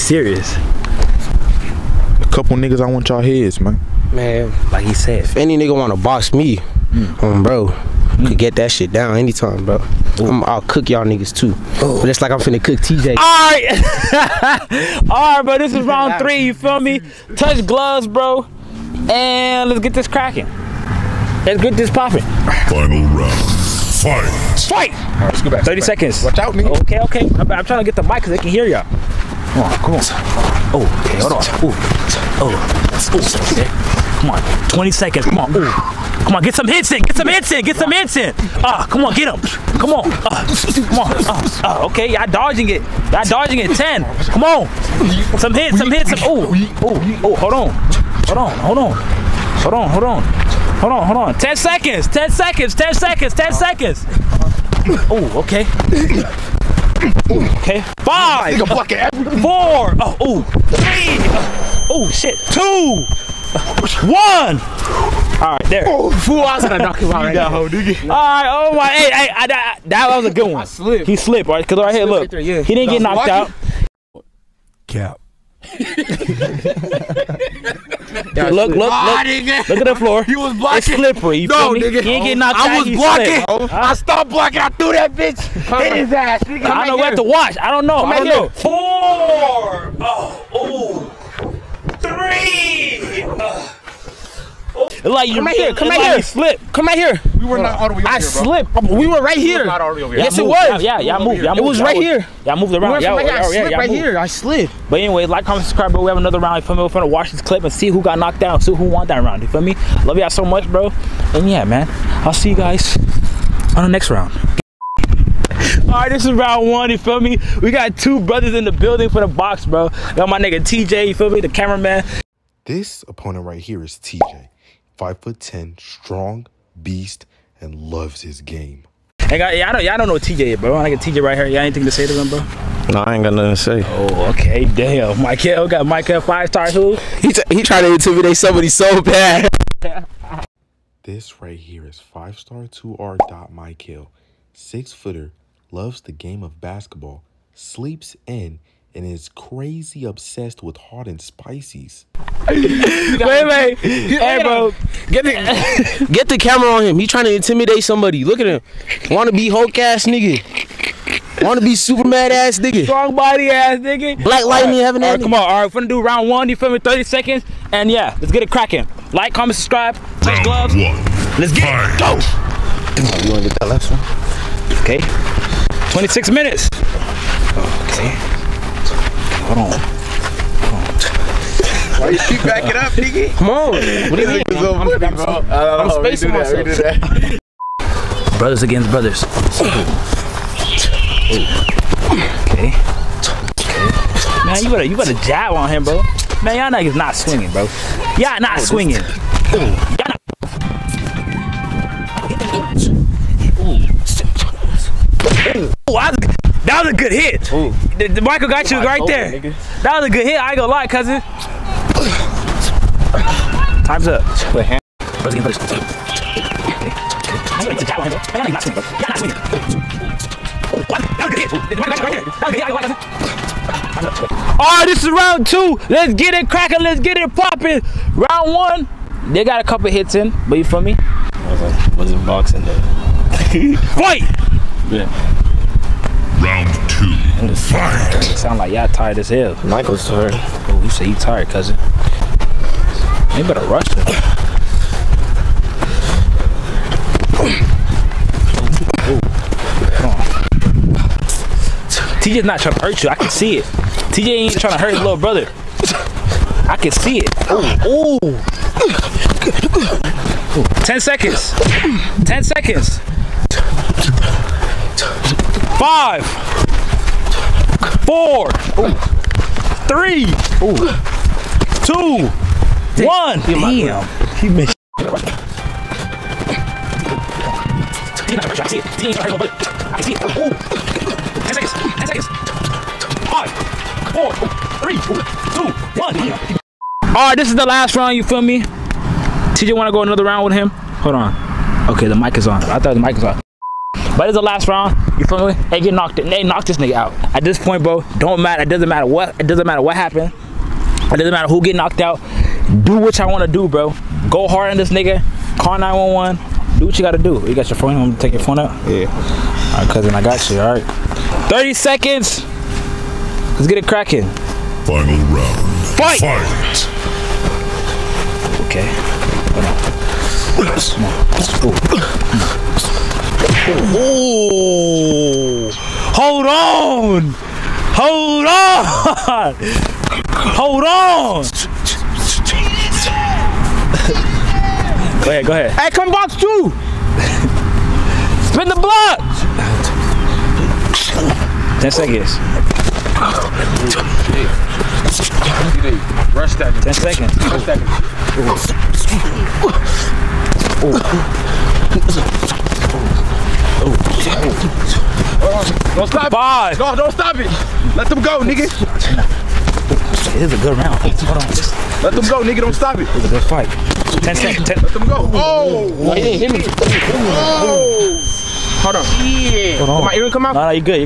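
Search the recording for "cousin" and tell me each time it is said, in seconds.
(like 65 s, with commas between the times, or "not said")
210 s, 241 s, 309 s.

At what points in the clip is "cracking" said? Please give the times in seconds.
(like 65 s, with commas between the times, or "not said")
20 s, 168 s, 226 s, 313 s.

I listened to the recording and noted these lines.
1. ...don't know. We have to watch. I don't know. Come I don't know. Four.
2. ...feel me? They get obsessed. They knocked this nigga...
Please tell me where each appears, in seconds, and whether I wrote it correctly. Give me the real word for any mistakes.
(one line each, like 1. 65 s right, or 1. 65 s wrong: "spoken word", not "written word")
1. 86 s right
2. 295 s wrong: "knocked", not "obsessed".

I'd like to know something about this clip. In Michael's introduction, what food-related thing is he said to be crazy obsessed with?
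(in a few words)
Hot and spices.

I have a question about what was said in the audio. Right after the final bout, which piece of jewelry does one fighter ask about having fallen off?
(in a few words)
Earring.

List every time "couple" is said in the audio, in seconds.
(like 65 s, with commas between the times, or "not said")
2 s, 229 s.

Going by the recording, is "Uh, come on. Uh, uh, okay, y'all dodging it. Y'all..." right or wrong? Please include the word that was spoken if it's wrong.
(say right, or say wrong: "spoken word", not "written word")
right.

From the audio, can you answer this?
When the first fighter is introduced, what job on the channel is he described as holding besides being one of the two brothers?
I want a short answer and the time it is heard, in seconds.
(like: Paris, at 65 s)
The cameraman, at 121 s.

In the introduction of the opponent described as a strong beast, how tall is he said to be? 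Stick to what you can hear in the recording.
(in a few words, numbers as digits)
5 foot 10.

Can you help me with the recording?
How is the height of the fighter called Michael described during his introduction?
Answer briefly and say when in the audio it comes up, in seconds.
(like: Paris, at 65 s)
Six footer, at 144 s.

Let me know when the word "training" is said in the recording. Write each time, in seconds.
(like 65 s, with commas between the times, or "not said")
not said.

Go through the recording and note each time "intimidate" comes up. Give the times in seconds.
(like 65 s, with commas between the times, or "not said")
137 s, 157 s.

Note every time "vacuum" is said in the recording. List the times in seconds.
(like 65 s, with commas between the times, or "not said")
not said.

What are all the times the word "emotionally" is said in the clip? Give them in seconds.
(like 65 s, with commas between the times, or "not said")
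not said.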